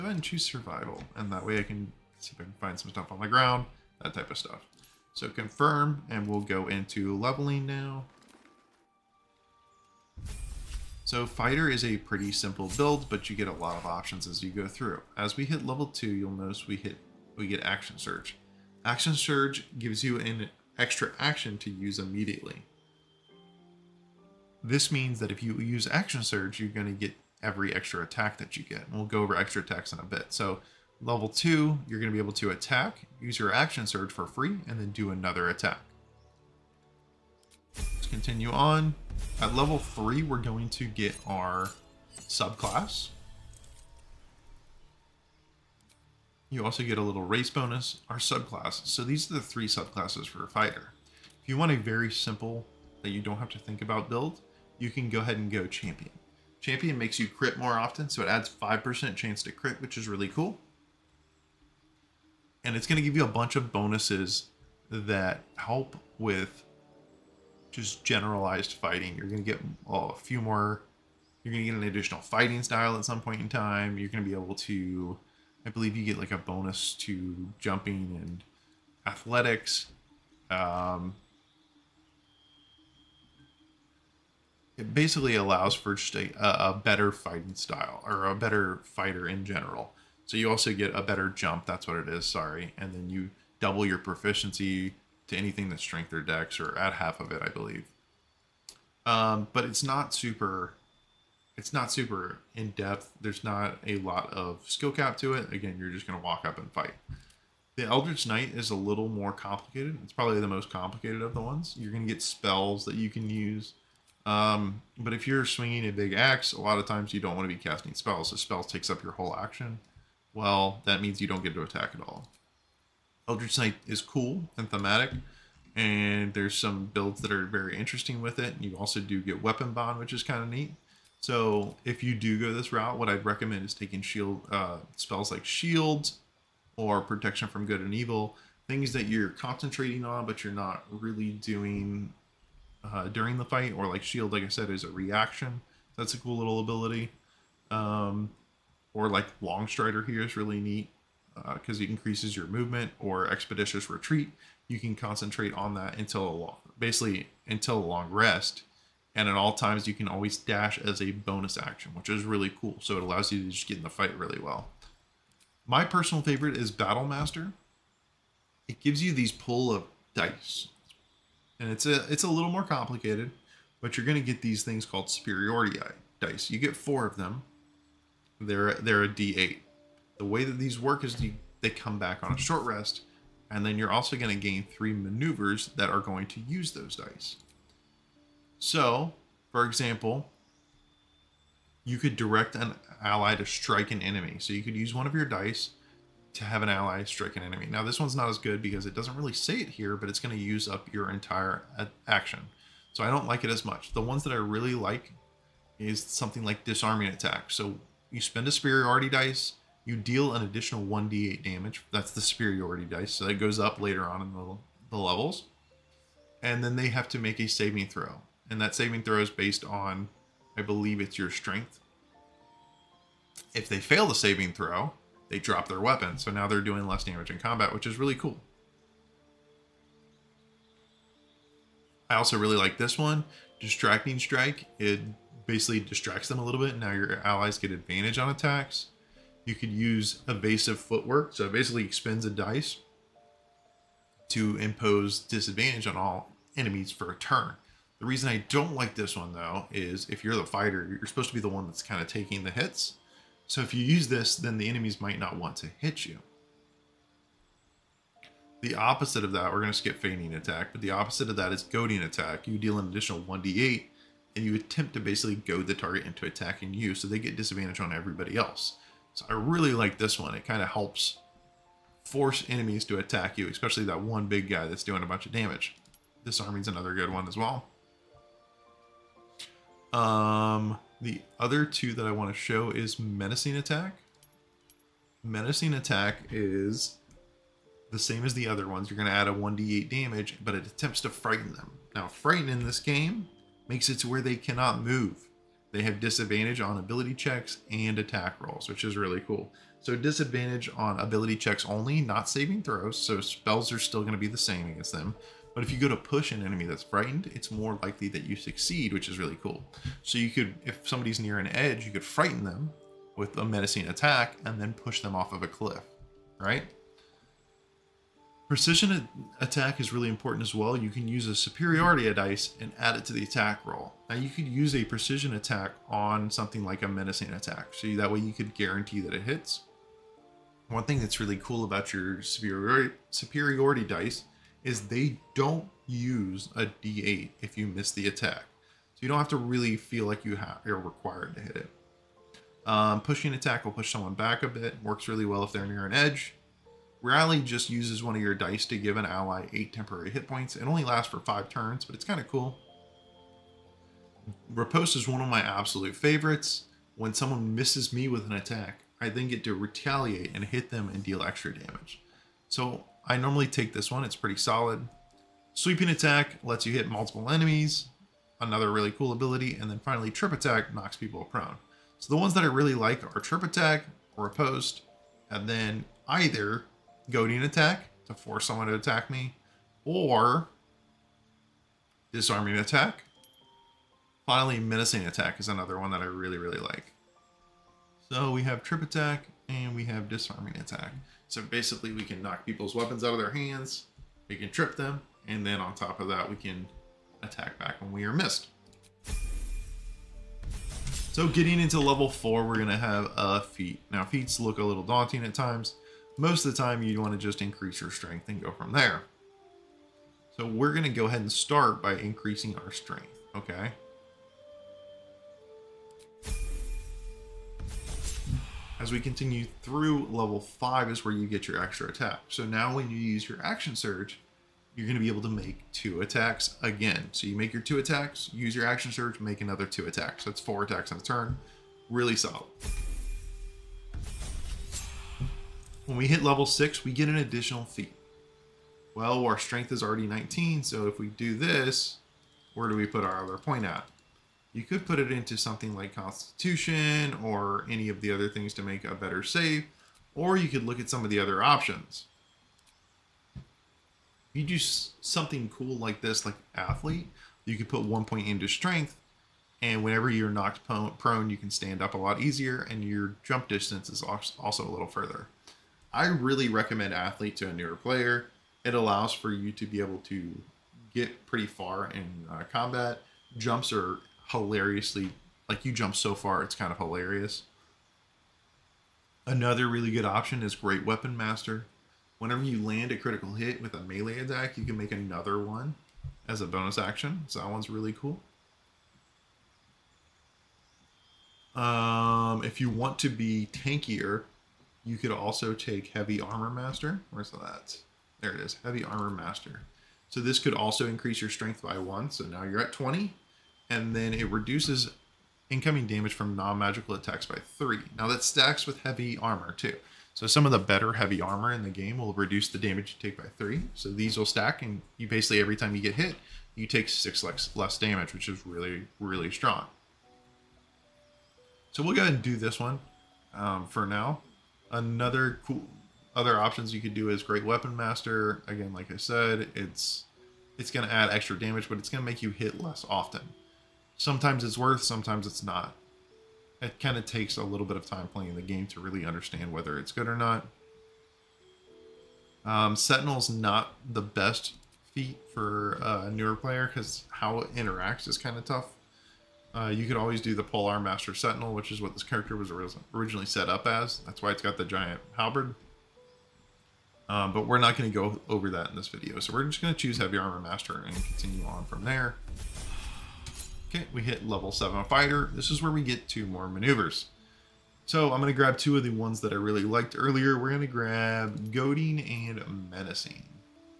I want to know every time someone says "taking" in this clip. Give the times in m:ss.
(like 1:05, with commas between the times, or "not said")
2:13, 4:12.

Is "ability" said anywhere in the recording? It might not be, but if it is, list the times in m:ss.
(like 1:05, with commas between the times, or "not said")
2:26, 4:56, 5:00, 6:09.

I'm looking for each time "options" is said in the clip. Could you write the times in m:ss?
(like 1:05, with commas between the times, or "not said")
0:13, 7:31, 8:00, 8:46.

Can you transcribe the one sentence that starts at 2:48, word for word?
It gives you these pull of dice.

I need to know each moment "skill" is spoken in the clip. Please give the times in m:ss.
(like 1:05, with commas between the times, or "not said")
1:44.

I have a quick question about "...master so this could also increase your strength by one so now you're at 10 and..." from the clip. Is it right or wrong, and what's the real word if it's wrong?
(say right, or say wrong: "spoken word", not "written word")
wrong: "20", not "10".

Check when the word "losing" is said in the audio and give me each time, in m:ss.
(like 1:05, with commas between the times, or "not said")
not said.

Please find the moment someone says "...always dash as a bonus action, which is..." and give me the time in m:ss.
2:40.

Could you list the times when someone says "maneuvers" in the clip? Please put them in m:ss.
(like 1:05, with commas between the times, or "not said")
3:04, 9:26.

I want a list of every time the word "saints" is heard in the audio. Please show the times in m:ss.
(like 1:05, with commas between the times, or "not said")
not said.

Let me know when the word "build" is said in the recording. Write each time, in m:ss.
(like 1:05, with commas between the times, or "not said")
0:12, 0:54, 2:06.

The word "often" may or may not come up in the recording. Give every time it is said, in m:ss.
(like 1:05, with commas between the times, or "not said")
0:57, 8:52.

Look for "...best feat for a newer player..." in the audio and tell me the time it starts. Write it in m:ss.
9:04.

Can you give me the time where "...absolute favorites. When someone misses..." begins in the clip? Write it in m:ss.
5:55.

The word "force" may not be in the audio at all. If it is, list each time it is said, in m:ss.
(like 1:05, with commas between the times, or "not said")
4:32, 6:18.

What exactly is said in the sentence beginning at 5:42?
Um, pushing attack will push someone back a bit.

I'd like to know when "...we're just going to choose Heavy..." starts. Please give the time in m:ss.
9:19.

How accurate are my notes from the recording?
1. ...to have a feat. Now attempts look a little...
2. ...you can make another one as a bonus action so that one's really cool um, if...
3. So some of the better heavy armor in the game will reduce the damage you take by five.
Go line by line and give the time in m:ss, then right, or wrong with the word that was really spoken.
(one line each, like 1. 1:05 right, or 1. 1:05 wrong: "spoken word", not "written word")
1. 6:42 wrong: "feats", not "attempts"
2. 8:04 right
3. 8:30 wrong: "three", not "five".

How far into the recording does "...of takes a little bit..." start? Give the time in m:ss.
8:56.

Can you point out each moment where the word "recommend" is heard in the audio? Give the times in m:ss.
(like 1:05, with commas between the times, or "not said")
2:13, 7:46.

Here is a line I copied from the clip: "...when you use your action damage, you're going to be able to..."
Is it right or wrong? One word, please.
wrong.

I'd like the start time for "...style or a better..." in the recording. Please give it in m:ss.
1:27.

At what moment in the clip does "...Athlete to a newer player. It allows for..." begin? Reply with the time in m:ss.
7:46.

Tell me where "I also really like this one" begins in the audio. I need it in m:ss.
3:52.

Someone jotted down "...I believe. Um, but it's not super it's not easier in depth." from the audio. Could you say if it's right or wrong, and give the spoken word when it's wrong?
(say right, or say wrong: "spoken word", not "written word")
wrong: "super", not "easier".